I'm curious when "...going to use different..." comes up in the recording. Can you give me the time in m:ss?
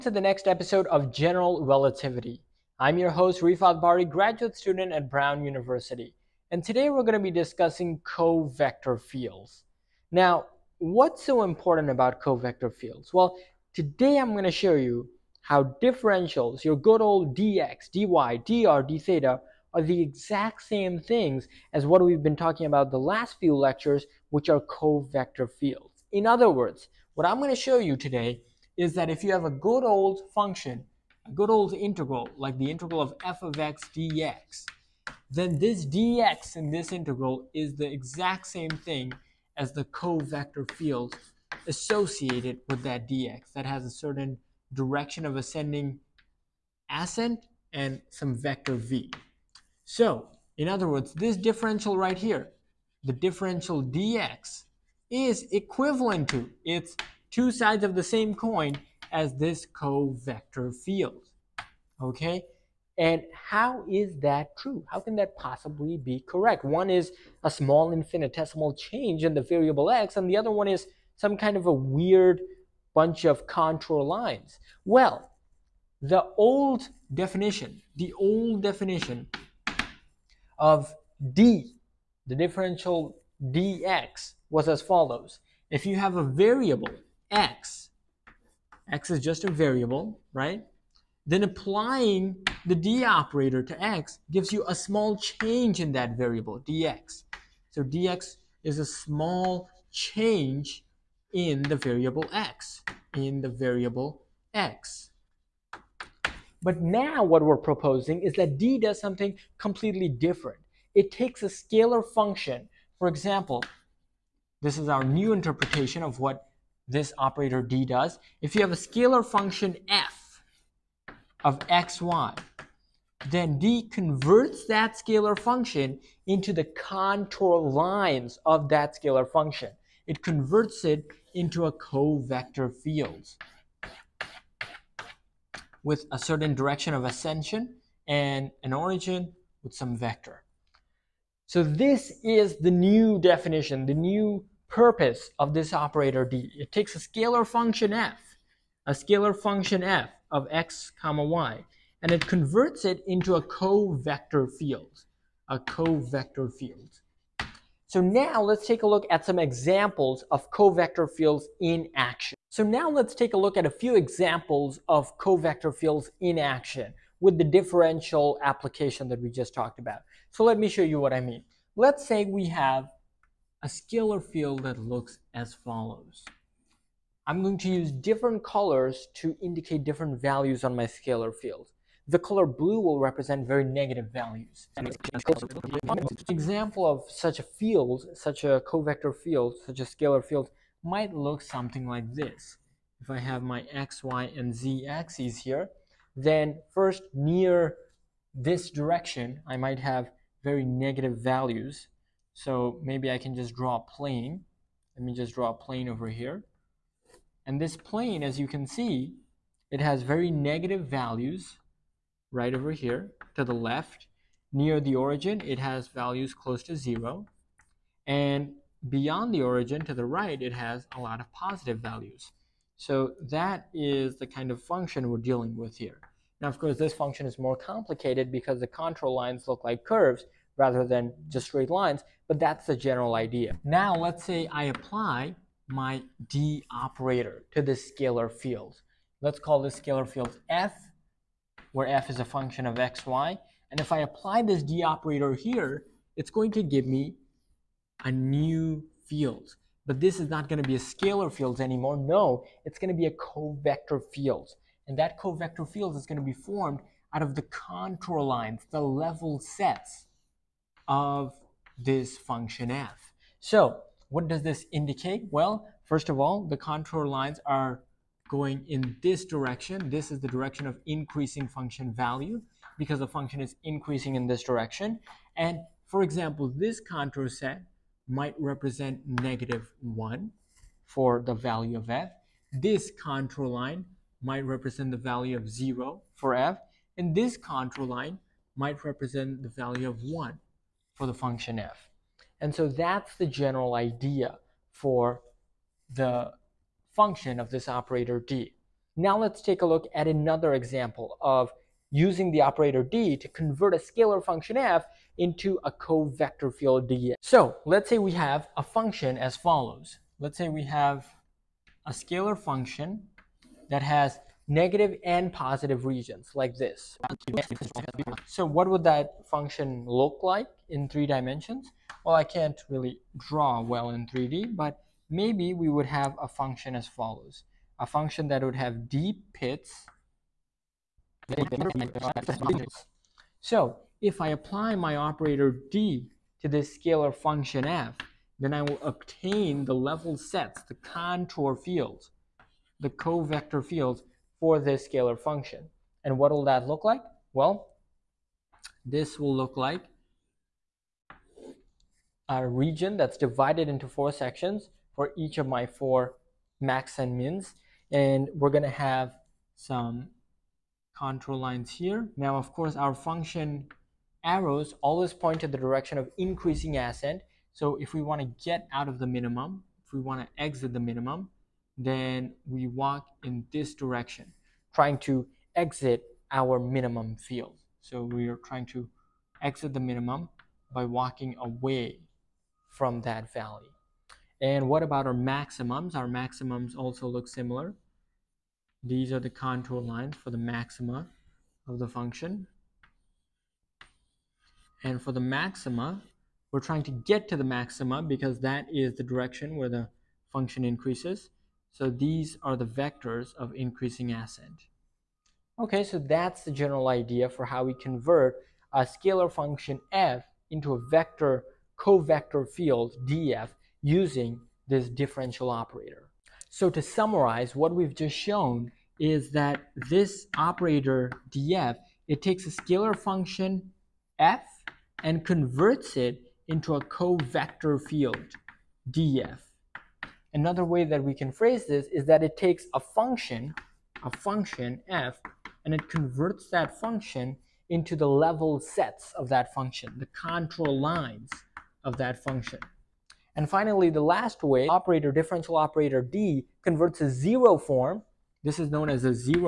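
2:57.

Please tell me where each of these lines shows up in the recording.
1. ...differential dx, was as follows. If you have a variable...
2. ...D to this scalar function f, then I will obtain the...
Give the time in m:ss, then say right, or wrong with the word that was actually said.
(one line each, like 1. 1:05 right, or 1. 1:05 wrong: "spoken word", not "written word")
1. 1:22 right
2. 5:35 right.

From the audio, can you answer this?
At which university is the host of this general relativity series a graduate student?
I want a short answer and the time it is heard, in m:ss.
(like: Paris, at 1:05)
Brown University, at 0:05.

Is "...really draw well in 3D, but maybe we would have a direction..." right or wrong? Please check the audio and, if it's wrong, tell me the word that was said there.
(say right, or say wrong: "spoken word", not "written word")
wrong: "function", not "direction".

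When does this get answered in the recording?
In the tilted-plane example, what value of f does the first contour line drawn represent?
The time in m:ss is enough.
4:39.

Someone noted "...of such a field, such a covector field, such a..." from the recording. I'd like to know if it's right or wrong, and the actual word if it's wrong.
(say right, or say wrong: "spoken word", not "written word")
right.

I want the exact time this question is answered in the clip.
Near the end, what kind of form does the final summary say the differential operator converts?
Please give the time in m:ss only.
7:26.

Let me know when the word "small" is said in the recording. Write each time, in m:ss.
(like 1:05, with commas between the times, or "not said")
1:07, 1:34, 1:38.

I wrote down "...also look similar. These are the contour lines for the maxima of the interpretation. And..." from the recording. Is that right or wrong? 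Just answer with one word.
wrong.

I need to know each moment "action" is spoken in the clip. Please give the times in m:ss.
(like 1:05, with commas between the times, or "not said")
2:41, 2:46.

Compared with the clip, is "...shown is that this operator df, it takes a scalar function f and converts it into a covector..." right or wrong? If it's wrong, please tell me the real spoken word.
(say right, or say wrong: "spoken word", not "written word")
right.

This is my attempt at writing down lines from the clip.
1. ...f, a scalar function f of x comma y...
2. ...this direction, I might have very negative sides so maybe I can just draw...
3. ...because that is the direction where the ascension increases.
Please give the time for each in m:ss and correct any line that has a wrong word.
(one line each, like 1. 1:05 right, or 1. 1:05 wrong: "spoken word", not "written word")
1. 2:27 right
2. 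3:18 wrong: "values", not "sides"
3. 6:38 wrong: "function", not "ascension".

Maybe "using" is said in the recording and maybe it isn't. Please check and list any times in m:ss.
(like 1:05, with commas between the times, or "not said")
5:01, 6:53.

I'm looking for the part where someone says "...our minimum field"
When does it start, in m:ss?
6:16.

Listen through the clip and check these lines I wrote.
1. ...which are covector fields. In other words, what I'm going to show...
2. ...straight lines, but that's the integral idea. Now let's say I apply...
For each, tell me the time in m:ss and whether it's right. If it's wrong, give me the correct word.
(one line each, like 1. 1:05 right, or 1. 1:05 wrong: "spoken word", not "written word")
1. 0:24 right
2. 3:51 wrong: "general", not "integral".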